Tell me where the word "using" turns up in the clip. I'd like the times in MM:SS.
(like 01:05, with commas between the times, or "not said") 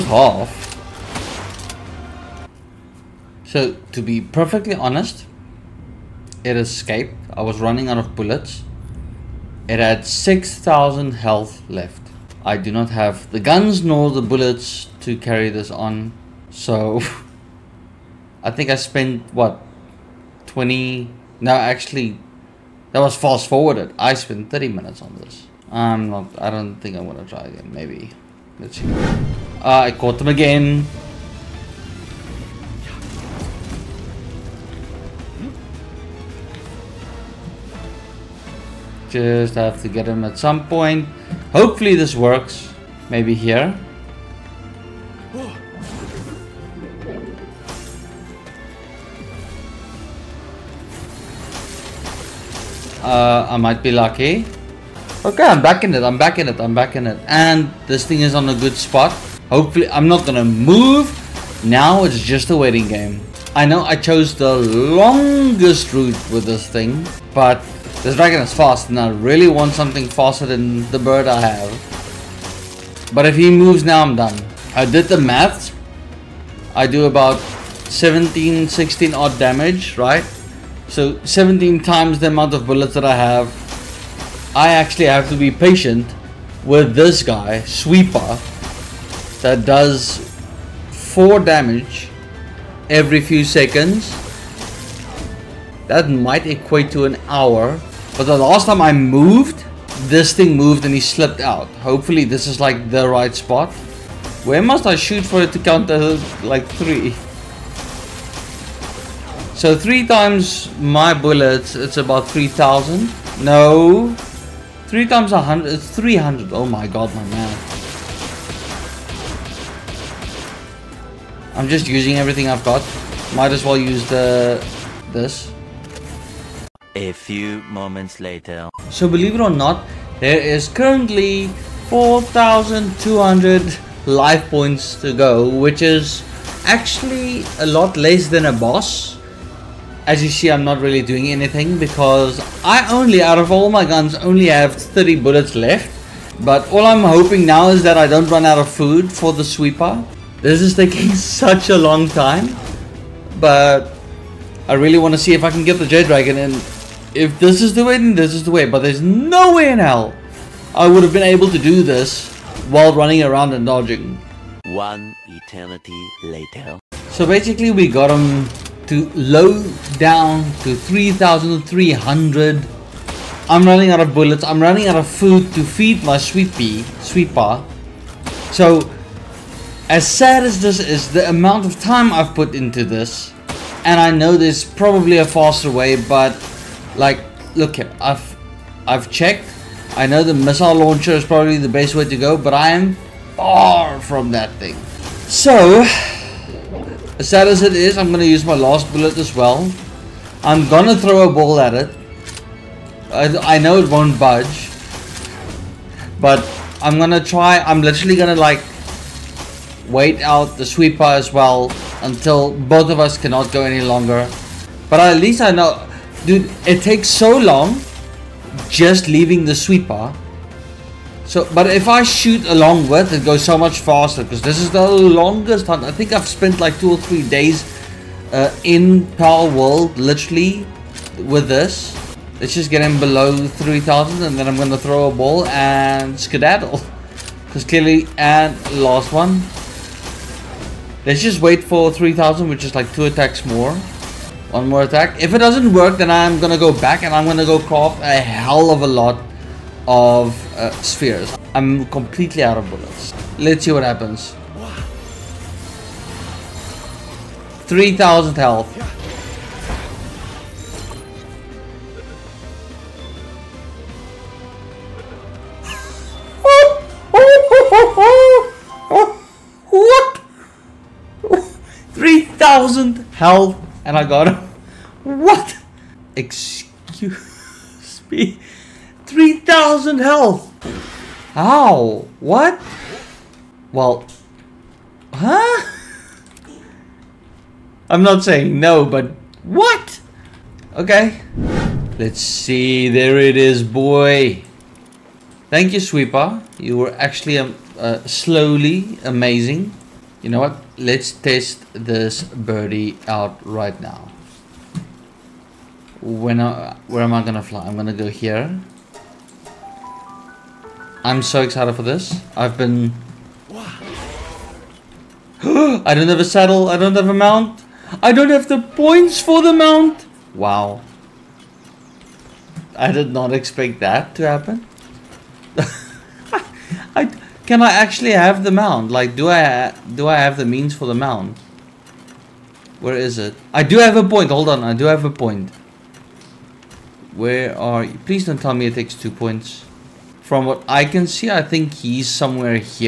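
02:01.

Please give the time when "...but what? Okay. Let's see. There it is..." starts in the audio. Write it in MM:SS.
04:48.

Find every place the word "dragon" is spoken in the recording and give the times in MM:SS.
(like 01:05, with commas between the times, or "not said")
01:08, 02:35.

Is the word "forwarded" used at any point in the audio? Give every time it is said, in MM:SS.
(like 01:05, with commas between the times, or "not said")
00:23.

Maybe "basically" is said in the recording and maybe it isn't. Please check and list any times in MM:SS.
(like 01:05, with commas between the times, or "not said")
02:47.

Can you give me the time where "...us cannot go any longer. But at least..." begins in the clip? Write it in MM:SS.
03:32.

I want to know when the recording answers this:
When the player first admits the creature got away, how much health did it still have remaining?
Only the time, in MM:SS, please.
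00:10.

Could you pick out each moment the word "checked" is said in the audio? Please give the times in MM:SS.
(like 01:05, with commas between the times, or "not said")
03:09.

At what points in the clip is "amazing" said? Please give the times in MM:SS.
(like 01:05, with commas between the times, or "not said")
04:59.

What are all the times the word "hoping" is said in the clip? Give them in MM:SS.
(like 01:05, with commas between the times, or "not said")
02:27.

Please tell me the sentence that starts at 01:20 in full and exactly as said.
So 17 times the amount of bullets that I have.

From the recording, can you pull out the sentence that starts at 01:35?
That might equate to an hour.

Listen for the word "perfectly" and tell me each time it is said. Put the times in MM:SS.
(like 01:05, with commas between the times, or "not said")
00:04.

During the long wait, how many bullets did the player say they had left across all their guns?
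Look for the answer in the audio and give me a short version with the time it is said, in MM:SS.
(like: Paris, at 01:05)
30, at 02:24.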